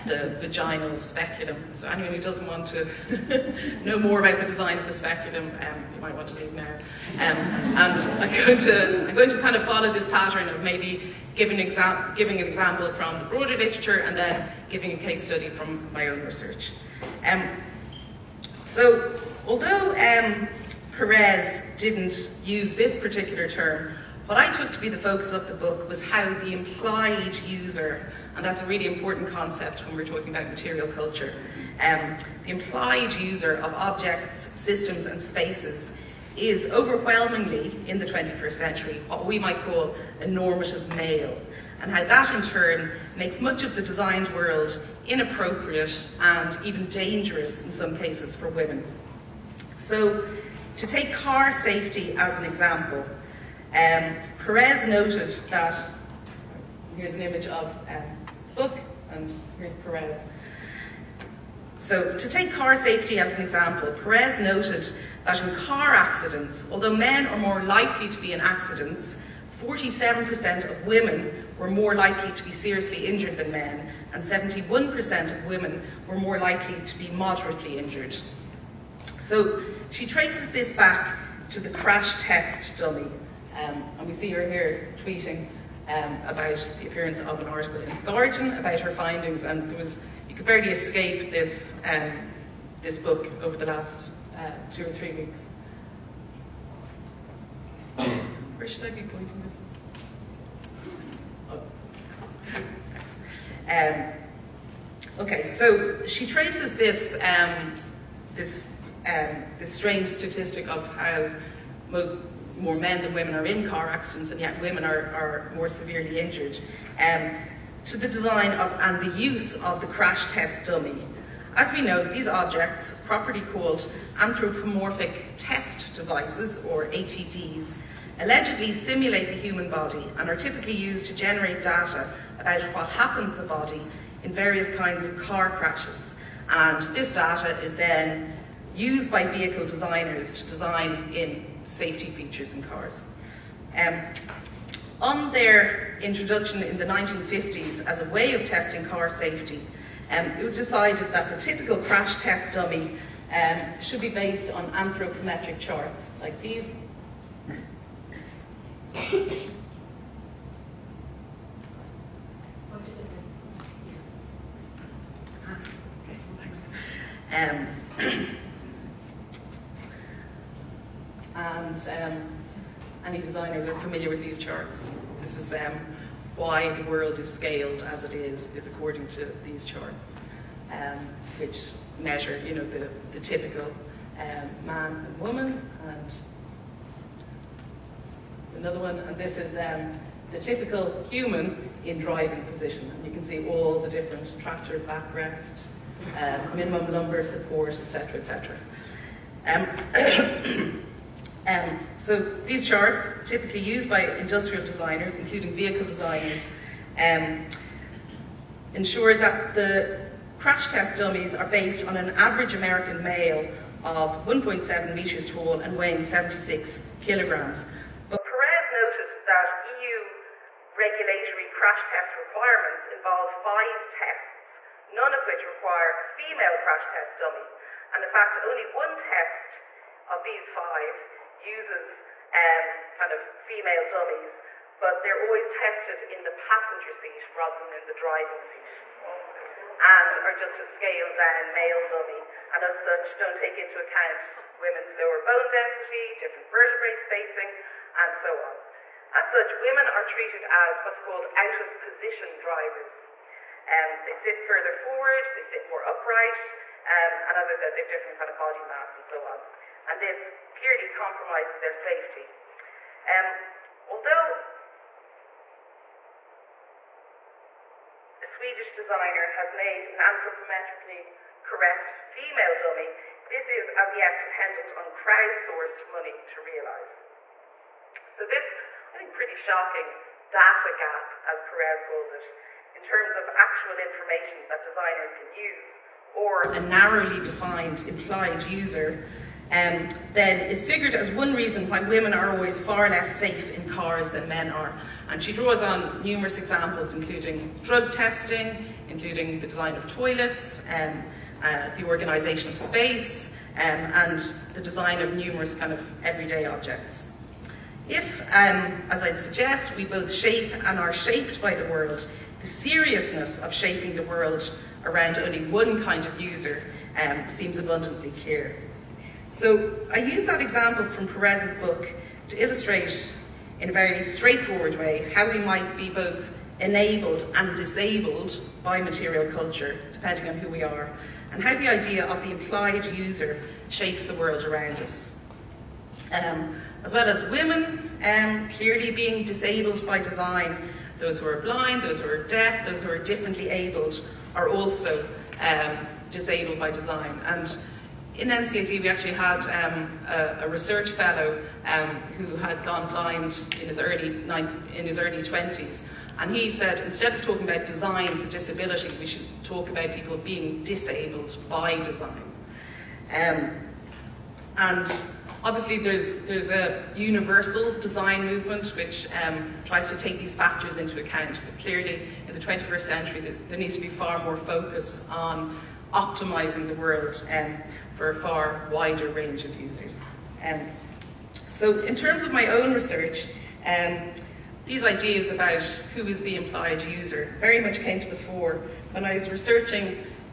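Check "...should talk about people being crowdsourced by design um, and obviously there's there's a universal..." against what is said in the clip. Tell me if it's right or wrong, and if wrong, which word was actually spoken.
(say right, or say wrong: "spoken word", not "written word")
wrong: "disabled", not "crowdsourced".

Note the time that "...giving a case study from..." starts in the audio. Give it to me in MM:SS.
00:14.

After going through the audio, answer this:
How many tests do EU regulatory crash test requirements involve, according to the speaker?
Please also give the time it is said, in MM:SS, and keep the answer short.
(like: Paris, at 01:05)
5, at 03:43.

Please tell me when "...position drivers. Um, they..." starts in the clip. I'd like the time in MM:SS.
04:11.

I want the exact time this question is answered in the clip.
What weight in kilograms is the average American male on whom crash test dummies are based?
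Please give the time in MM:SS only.
03:36.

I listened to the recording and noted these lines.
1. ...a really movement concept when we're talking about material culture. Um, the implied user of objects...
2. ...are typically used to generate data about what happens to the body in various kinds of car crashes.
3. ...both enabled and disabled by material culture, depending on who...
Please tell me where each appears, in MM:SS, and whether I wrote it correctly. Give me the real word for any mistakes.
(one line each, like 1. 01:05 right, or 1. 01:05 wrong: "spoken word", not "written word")
1. 00:28 wrong: "important", not "movement"
2. 02:10 right
3. 05:25 right.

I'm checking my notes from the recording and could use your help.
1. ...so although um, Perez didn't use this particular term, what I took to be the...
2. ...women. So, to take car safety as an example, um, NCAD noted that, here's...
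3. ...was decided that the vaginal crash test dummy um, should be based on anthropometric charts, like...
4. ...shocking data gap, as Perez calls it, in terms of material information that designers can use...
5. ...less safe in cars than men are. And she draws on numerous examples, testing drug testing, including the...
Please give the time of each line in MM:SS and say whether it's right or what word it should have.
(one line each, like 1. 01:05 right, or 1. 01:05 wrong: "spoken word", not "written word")
1. 00:18 right
2. 00:48 wrong: "Perez", not "NCAD"
3. 02:30 wrong: "typical", not "vaginal"
4. 04:39 wrong: "actual", not "material"
5. 04:52 wrong: "including", not "testing".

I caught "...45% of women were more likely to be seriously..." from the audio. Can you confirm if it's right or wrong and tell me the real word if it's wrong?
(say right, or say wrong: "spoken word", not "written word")
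wrong: "47", not "45".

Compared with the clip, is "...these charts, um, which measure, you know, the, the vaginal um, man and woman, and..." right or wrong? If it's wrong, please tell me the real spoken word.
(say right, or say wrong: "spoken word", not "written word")
wrong: "typical", not "vaginal".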